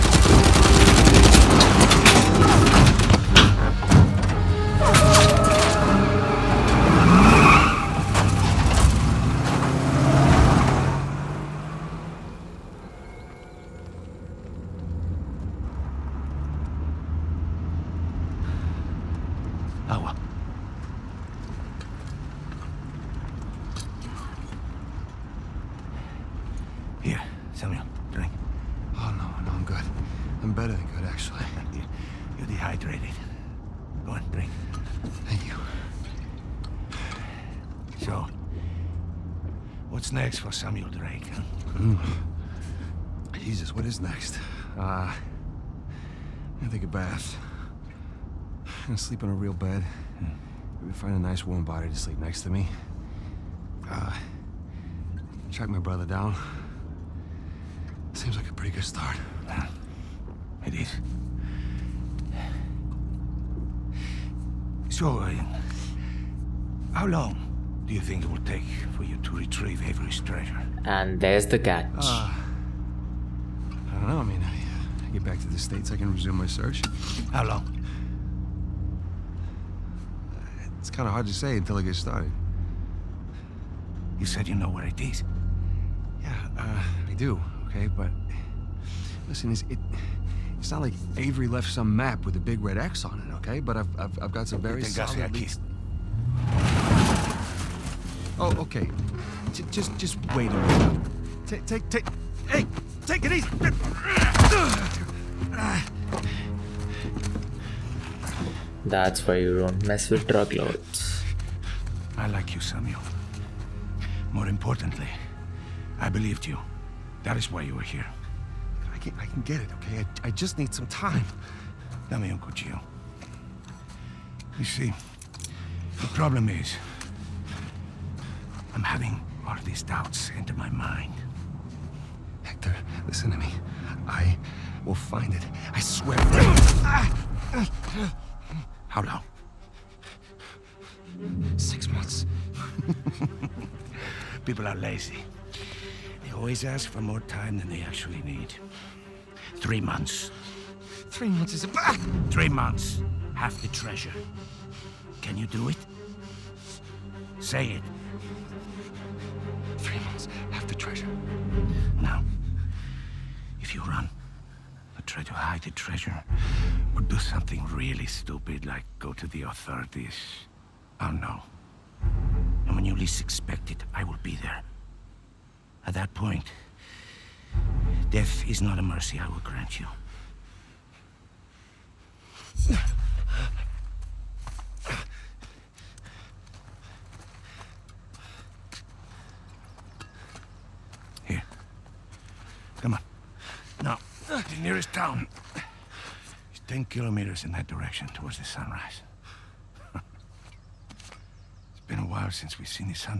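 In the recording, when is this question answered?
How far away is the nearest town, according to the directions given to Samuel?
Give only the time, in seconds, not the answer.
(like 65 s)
196 s.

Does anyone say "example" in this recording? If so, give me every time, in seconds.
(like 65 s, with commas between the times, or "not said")
not said.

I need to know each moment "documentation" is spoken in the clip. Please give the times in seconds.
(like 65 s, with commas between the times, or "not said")
not said.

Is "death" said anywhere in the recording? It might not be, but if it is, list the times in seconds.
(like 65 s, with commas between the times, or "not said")
178 s.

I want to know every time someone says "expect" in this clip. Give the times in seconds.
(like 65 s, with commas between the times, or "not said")
173 s.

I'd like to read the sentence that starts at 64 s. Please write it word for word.
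So, uh, how long do you think it will take for you to retrieve Avery's treasure?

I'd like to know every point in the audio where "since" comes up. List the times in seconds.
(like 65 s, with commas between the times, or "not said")
202 s.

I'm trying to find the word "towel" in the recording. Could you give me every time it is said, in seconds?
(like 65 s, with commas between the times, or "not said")
not said.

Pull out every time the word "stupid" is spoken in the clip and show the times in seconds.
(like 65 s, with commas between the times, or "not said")
168 s.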